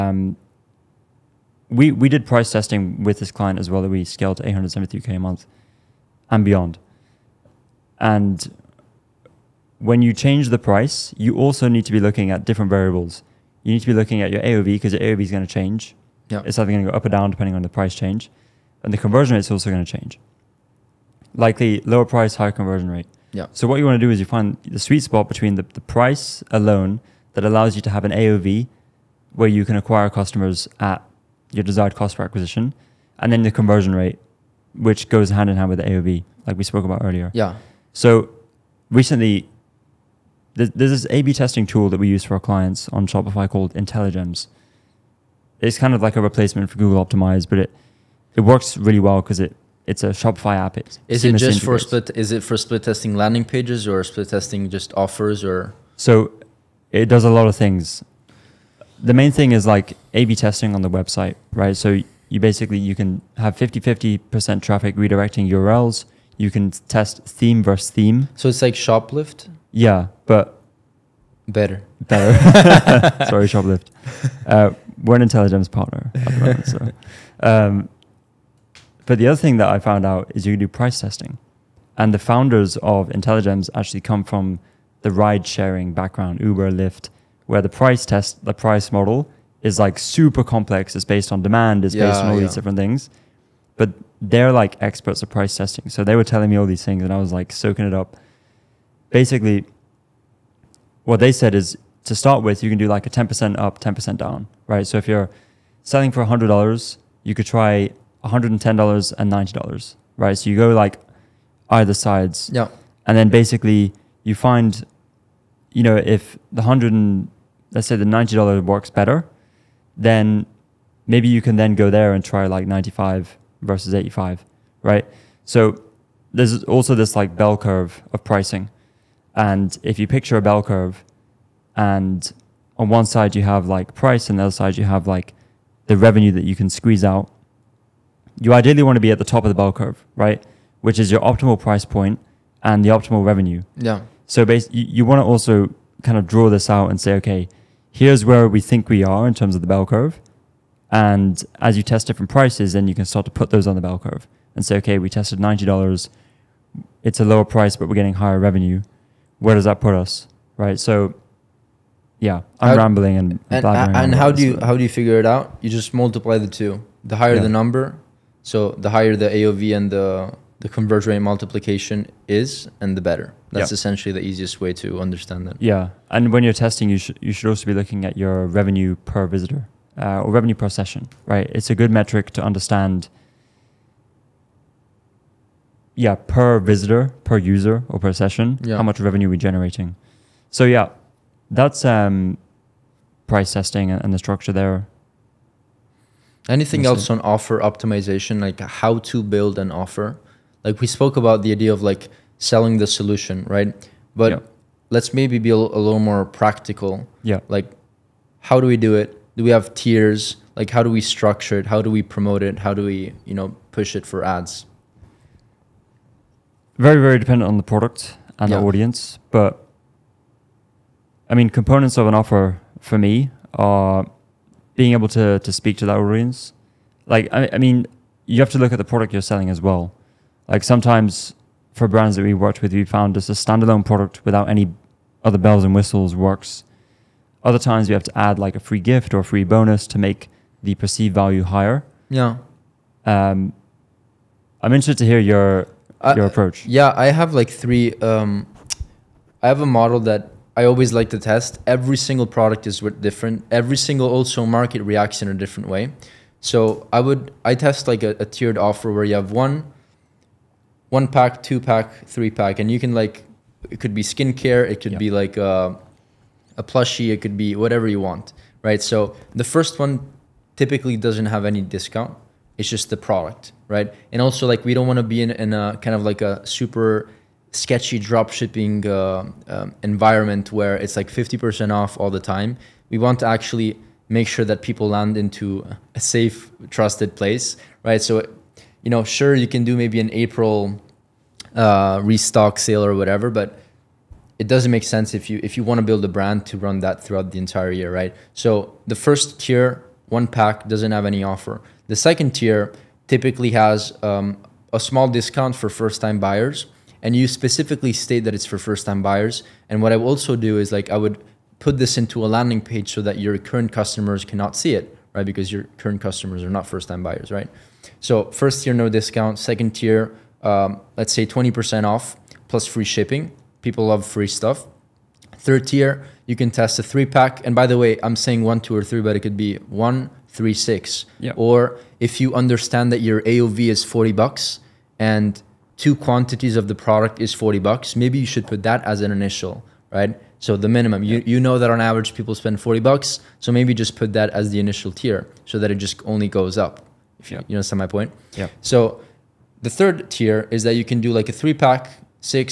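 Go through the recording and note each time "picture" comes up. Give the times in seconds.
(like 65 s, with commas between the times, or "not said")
130 s.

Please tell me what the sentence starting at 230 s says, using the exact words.
Like sometimes for brands that we worked with, we found just a standalone product without any other bells and whistles works.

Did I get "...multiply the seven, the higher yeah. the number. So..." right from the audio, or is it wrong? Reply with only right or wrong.
wrong.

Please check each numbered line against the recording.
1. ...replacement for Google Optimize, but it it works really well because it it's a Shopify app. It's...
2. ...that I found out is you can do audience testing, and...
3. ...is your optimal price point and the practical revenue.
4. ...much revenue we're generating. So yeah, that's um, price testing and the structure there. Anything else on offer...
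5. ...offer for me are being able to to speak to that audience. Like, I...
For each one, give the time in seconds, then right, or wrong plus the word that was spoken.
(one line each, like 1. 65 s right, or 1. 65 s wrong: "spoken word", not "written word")
1. 46 s right
2. 79 s wrong: "price", not "audience"
3. 140 s wrong: "optimal", not "practical"
4. 188 s right
5. 222 s right.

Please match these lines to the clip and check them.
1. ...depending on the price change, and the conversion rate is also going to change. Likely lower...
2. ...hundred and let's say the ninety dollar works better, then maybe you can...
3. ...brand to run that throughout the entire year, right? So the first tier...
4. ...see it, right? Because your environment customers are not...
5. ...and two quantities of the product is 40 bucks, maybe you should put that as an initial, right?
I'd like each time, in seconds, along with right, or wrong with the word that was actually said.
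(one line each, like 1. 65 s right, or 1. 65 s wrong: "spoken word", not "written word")
1. 17 s right
2. 116 s right
3. 296 s right
4. 314 s wrong: "current", not "environment"
5. 334 s right.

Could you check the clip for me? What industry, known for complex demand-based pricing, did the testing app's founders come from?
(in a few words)
Ride sharing.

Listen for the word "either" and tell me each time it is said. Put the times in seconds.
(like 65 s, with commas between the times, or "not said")
16 s, 111 s.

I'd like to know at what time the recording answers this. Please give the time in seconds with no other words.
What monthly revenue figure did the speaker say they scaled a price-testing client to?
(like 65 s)
4 s.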